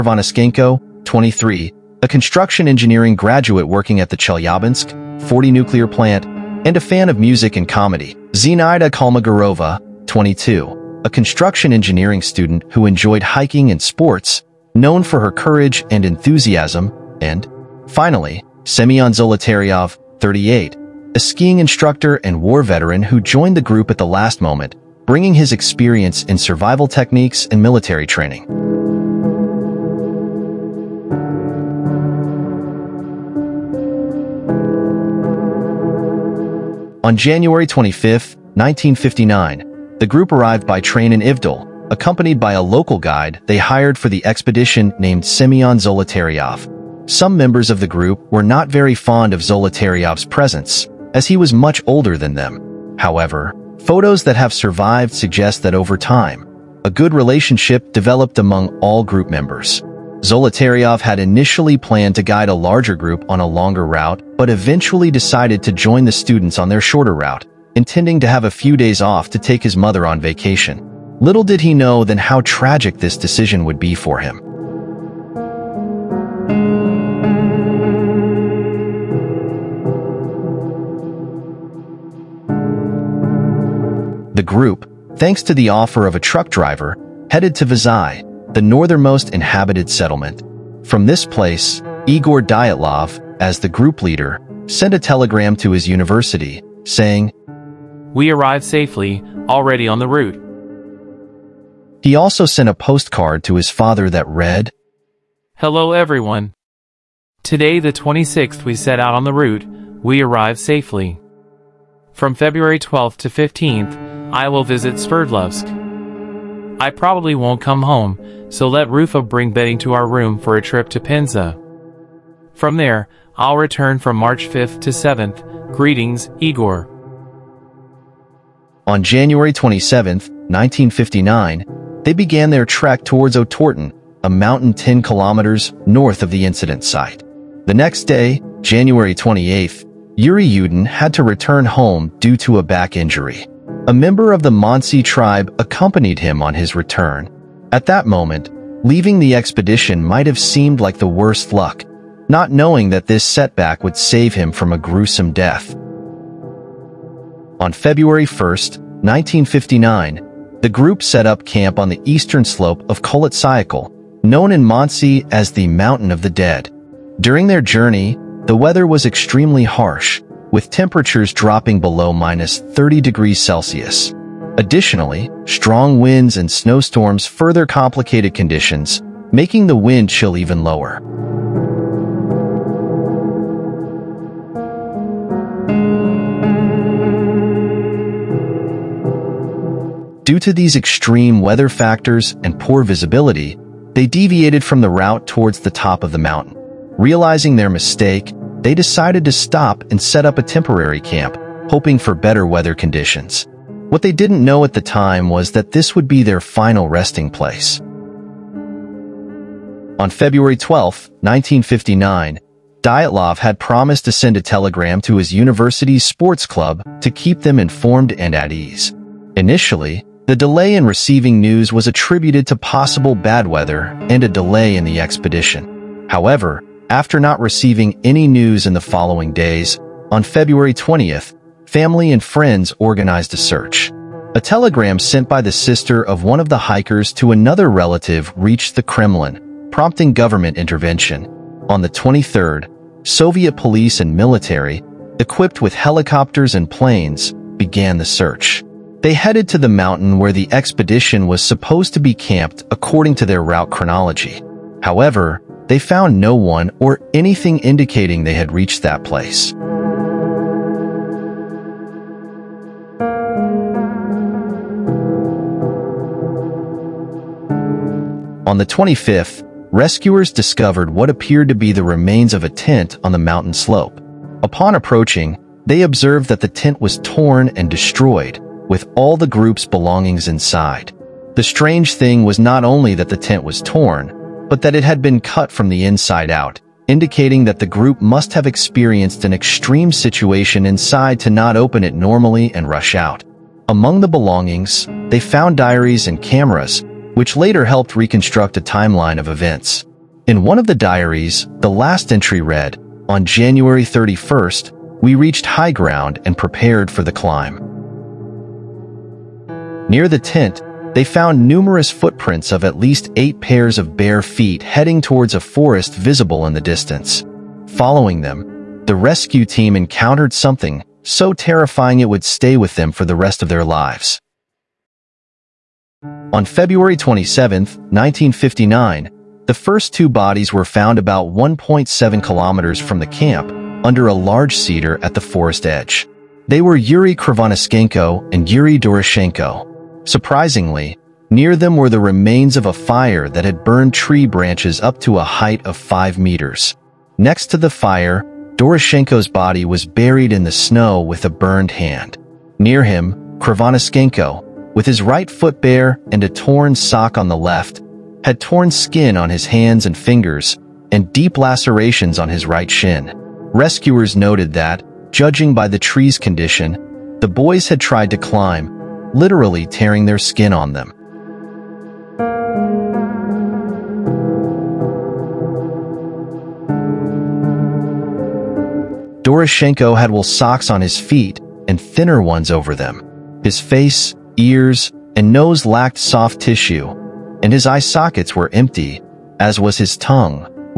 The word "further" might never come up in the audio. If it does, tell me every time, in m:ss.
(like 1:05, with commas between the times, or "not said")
2:57.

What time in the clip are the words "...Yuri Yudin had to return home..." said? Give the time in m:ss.
2:20.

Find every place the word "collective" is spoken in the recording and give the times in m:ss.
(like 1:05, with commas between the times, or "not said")
not said.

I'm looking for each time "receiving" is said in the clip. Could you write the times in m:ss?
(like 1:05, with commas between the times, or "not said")
3:40, 3:47.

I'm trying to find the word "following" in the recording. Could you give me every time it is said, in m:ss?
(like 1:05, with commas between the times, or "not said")
3:48, 5:17.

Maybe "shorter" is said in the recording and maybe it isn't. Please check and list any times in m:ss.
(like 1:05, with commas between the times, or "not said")
1:06.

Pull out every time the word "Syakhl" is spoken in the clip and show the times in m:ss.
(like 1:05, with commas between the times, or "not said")
2:43.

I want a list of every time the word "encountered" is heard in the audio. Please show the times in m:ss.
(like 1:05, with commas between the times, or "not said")
5:19.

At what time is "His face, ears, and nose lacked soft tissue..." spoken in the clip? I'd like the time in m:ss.
6:23.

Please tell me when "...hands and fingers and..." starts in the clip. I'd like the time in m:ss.
5:59.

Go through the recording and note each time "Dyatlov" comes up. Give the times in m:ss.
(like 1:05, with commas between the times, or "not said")
1:32, 3:32.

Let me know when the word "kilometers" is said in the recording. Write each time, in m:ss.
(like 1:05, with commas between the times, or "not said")
2:15, 5:32.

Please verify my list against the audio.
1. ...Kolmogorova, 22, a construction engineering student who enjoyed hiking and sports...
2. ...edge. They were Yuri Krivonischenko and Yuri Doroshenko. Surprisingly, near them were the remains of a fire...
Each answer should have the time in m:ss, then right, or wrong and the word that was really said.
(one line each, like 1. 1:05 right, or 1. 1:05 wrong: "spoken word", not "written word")
1. 0:08 right
2. 5:35 right.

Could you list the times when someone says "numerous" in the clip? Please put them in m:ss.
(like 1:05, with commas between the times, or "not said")
5:11.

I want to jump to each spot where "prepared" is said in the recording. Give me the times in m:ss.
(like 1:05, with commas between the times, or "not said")
5:06.